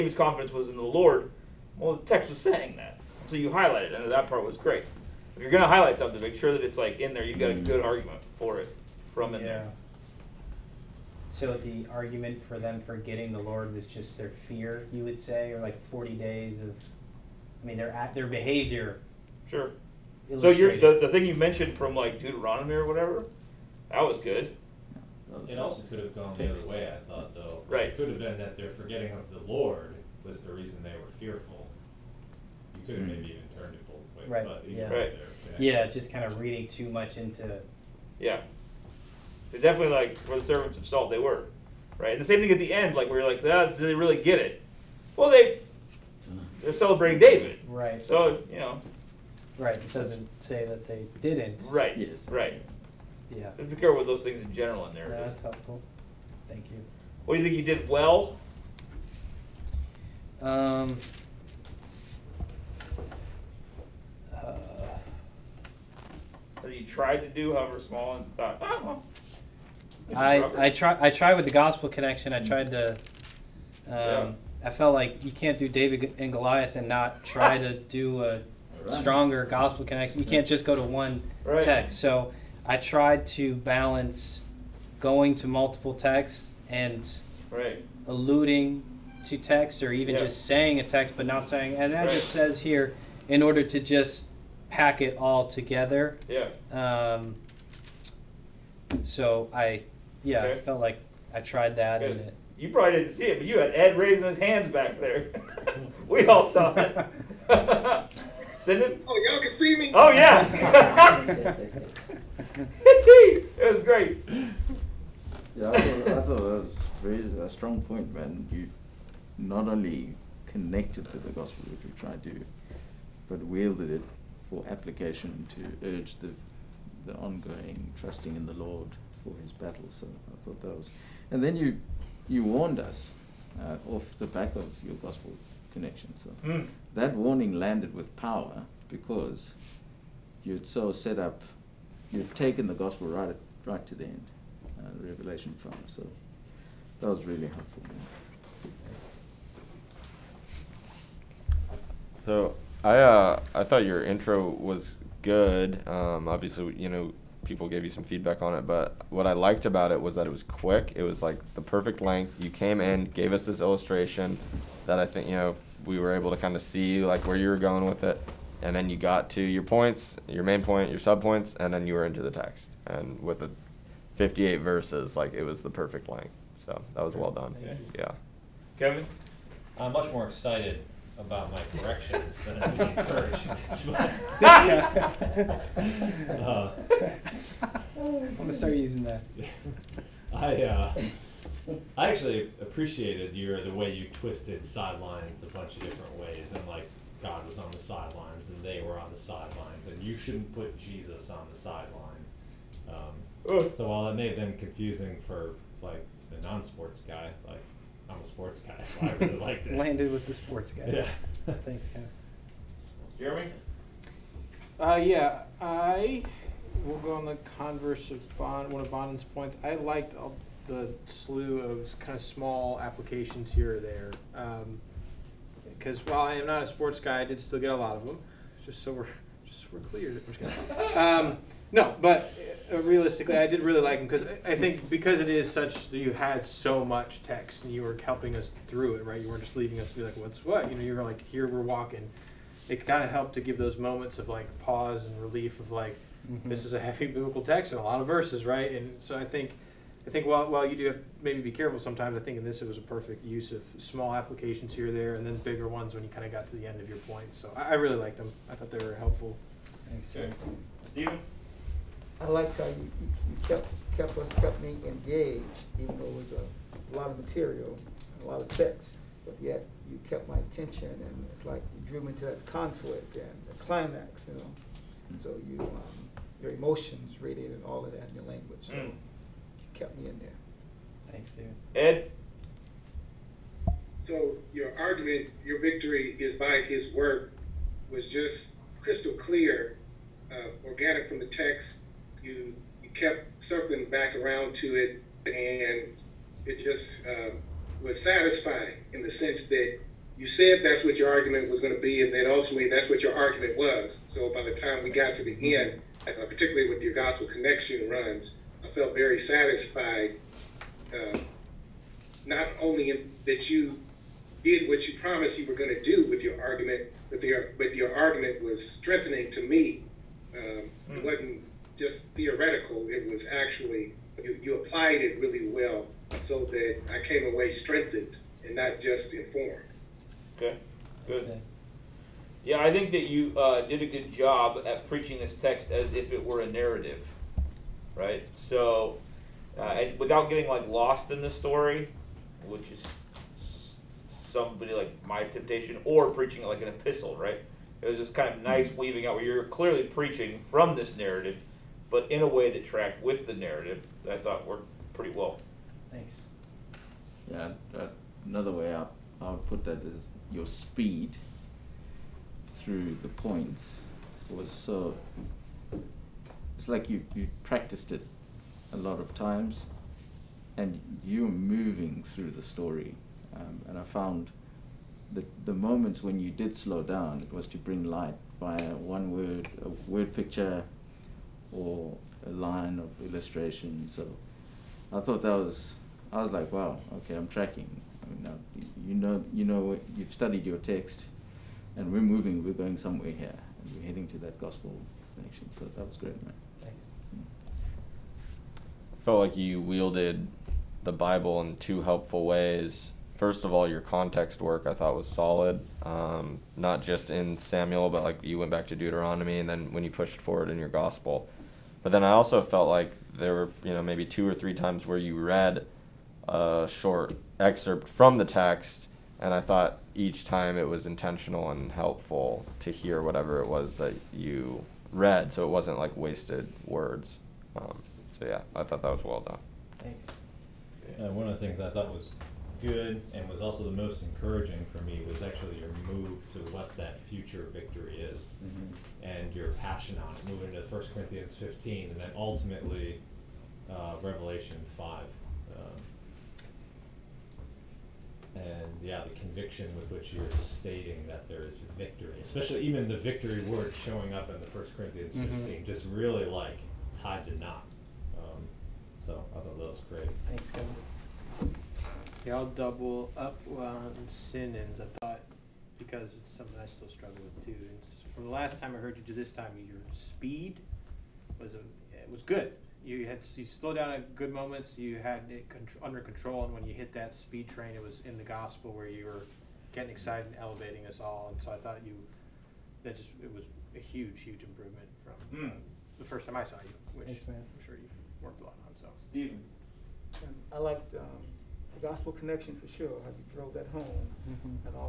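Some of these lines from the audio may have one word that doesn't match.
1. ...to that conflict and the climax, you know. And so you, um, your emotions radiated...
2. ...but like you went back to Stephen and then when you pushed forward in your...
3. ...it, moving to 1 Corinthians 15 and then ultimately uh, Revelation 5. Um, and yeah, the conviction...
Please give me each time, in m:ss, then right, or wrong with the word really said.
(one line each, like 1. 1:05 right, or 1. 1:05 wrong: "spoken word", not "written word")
1. 4:32 right
2. 6:47 wrong: "Deuteronomy", not "Stephen"
3. 7:20 right.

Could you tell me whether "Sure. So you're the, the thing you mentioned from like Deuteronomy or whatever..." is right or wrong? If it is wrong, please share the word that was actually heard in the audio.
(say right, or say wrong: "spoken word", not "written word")
right.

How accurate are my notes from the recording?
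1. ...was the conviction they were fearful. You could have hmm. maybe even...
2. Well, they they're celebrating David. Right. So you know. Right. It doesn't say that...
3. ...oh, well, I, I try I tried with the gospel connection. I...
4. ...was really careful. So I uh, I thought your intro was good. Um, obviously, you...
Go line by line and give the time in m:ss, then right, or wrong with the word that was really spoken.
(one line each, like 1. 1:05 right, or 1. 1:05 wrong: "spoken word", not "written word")
1. 0:30 wrong: "reason", not "conviction"
2. 0:45 right
3. 1:08 right
4. 2:27 wrong: "helpful", not "careful".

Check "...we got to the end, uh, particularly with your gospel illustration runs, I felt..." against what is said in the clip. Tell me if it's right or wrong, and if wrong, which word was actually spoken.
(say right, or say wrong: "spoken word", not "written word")
wrong: "connection", not "illustration".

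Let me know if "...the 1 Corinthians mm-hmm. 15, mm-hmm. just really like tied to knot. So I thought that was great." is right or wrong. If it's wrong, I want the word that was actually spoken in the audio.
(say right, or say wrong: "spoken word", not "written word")
right.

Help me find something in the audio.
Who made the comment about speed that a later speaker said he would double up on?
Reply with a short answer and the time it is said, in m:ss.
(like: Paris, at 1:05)
Sinan, at 7:44.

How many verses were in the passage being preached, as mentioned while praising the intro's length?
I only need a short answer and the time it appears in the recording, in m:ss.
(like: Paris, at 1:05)
58, at 2:54.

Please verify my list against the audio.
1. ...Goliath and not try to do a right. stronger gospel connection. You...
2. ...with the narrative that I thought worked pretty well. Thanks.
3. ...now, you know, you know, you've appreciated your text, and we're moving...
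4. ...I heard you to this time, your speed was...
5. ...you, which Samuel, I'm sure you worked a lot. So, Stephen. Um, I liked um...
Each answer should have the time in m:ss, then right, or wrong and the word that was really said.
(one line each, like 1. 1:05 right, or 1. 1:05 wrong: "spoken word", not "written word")
1. 1:16 right
2. 5:53 right
3. 6:28 wrong: "studied", not "appreciated"
4. 7:48 right
5. 8:06 wrong: "Thanks", not "Samuel".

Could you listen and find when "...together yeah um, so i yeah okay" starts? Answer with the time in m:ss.
1:35.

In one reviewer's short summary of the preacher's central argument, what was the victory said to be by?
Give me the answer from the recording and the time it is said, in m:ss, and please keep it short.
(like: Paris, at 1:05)
his work, at 4:46.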